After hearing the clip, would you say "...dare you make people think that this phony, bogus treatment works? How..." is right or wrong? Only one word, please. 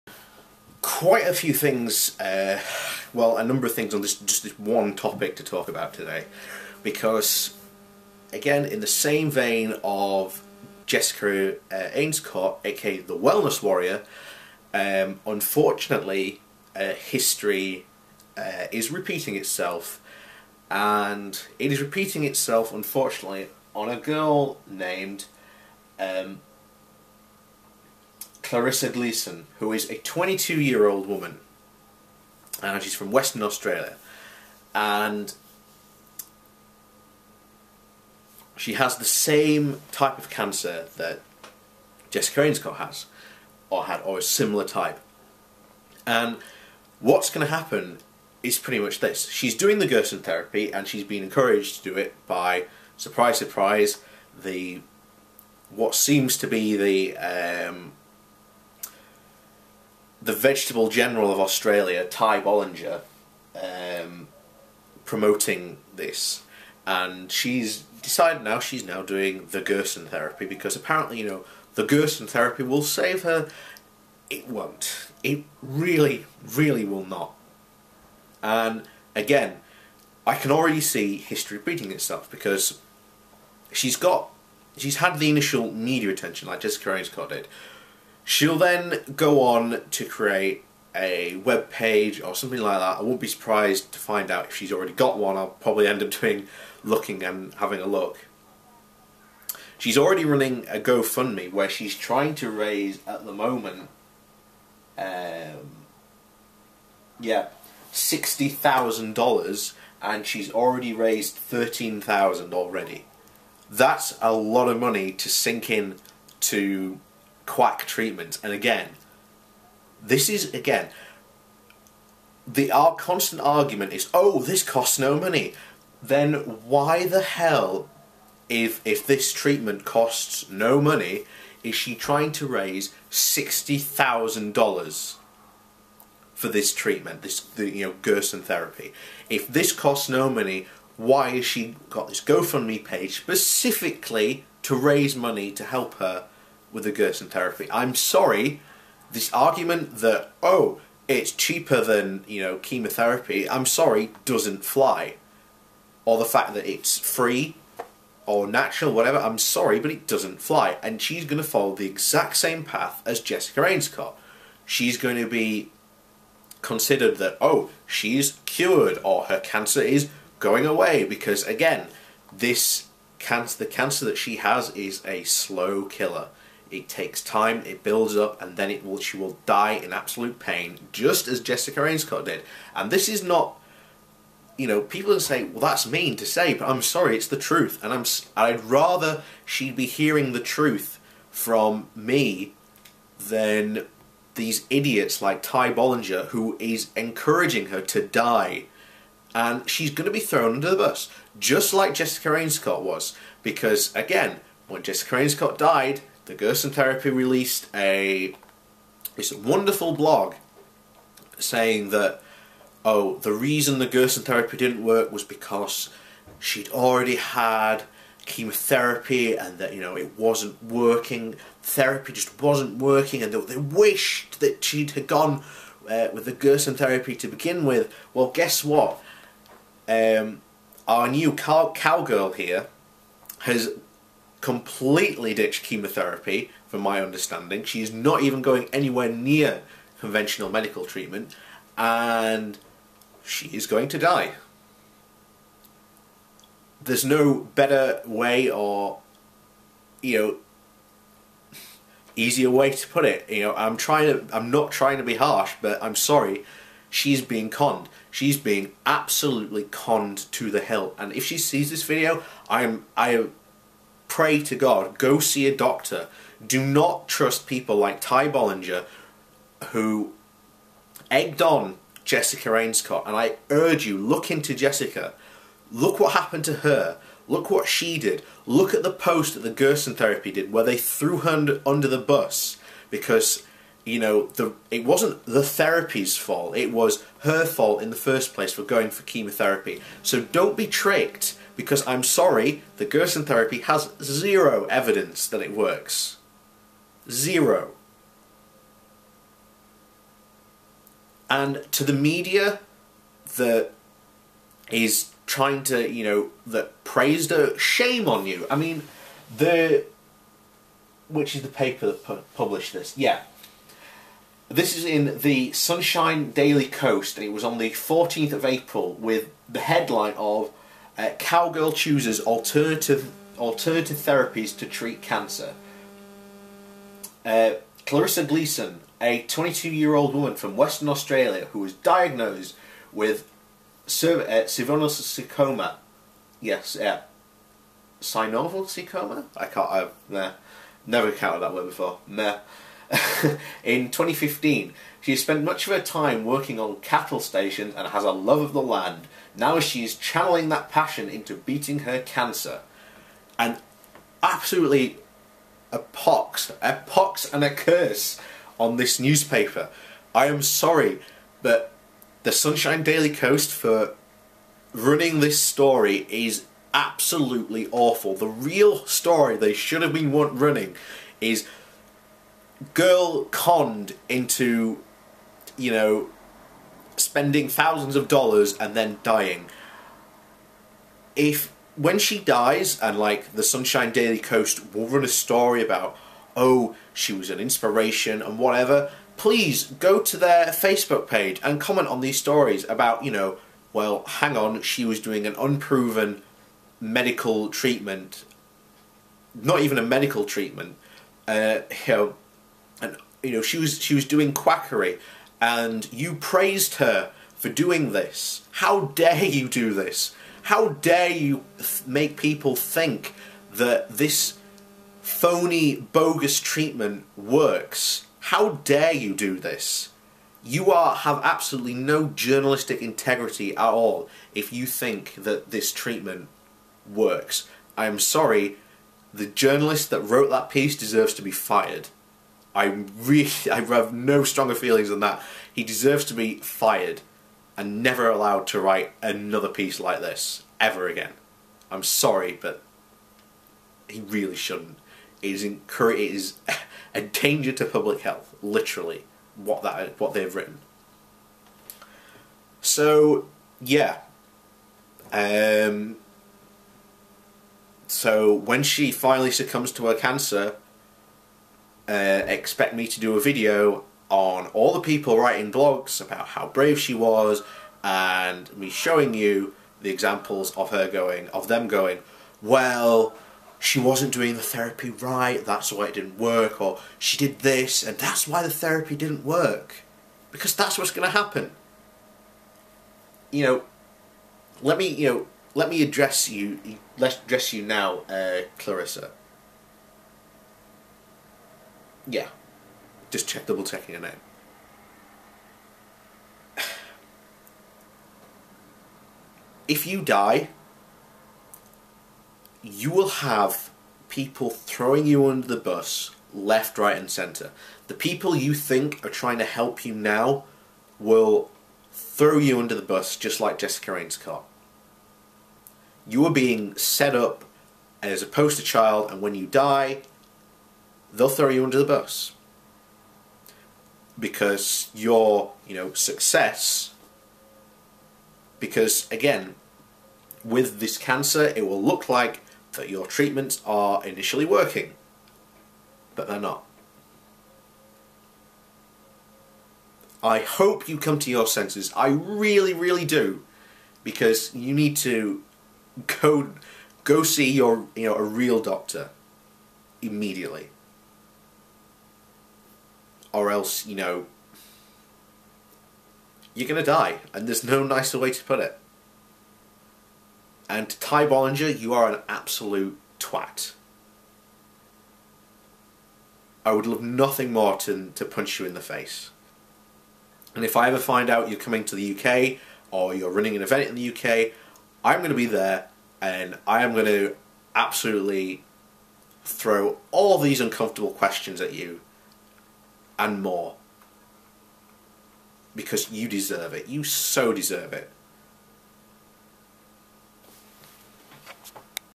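right.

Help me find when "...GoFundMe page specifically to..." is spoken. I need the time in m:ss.
2:22.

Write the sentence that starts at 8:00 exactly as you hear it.
Because that's what's going to happen.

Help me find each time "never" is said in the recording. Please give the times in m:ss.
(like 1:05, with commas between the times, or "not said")
5:40, 7:17.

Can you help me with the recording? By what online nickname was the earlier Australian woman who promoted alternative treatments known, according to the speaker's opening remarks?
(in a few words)
The Wellness Warrior.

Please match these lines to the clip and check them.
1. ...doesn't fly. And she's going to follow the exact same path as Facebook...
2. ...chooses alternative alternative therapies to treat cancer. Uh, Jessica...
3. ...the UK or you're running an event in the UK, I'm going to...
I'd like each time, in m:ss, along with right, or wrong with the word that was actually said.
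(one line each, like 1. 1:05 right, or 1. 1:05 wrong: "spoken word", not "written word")
1. 2:40 wrong: "Jessica", not "Facebook"
2. 5:21 wrong: "Carissa", not "Jessica"
3. 9:31 right.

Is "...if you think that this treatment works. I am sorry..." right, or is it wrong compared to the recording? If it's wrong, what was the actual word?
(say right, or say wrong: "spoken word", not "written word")
right.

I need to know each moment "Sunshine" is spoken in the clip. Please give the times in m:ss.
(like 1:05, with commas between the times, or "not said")
5:15, 6:02, 6:23.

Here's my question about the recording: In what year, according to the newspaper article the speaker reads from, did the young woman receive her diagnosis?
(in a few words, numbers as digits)
2015.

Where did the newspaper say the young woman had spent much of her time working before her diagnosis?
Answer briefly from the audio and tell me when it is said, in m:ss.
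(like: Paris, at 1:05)
Cattle stations, at 5:46.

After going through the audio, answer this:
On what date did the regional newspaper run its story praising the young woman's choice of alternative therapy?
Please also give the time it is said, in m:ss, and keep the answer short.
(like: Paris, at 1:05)
14 April, at 5:17.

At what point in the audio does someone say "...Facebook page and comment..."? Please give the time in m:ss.
6:30.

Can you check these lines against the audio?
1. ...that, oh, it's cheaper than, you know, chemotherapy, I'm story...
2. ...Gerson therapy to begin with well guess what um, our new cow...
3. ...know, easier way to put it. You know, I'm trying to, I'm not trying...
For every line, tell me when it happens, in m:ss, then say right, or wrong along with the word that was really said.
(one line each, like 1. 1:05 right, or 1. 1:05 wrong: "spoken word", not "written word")
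1. 2:29 wrong: "sorry", not "story"
2. 3:46 right
3. 4:10 right.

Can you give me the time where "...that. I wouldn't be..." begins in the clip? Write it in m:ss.
1:32.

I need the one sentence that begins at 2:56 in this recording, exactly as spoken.
It takes time, it builds up, and then it will, she will die in absolute pain, just as Jessica Rainscott did.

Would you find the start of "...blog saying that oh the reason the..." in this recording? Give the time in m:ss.
3:29.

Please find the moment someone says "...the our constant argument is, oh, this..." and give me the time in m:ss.
2:02.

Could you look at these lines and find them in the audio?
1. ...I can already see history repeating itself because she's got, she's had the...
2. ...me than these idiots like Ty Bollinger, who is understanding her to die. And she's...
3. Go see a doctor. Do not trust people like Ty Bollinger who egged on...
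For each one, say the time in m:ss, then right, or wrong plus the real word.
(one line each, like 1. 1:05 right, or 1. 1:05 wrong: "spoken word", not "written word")
1. 1:20 right
2. 3:11 wrong: "encouraging", not "understanding"
3. 4:24 right.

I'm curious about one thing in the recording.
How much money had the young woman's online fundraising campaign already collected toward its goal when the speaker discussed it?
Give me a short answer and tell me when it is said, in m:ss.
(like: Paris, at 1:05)
$13,000, at 1:51.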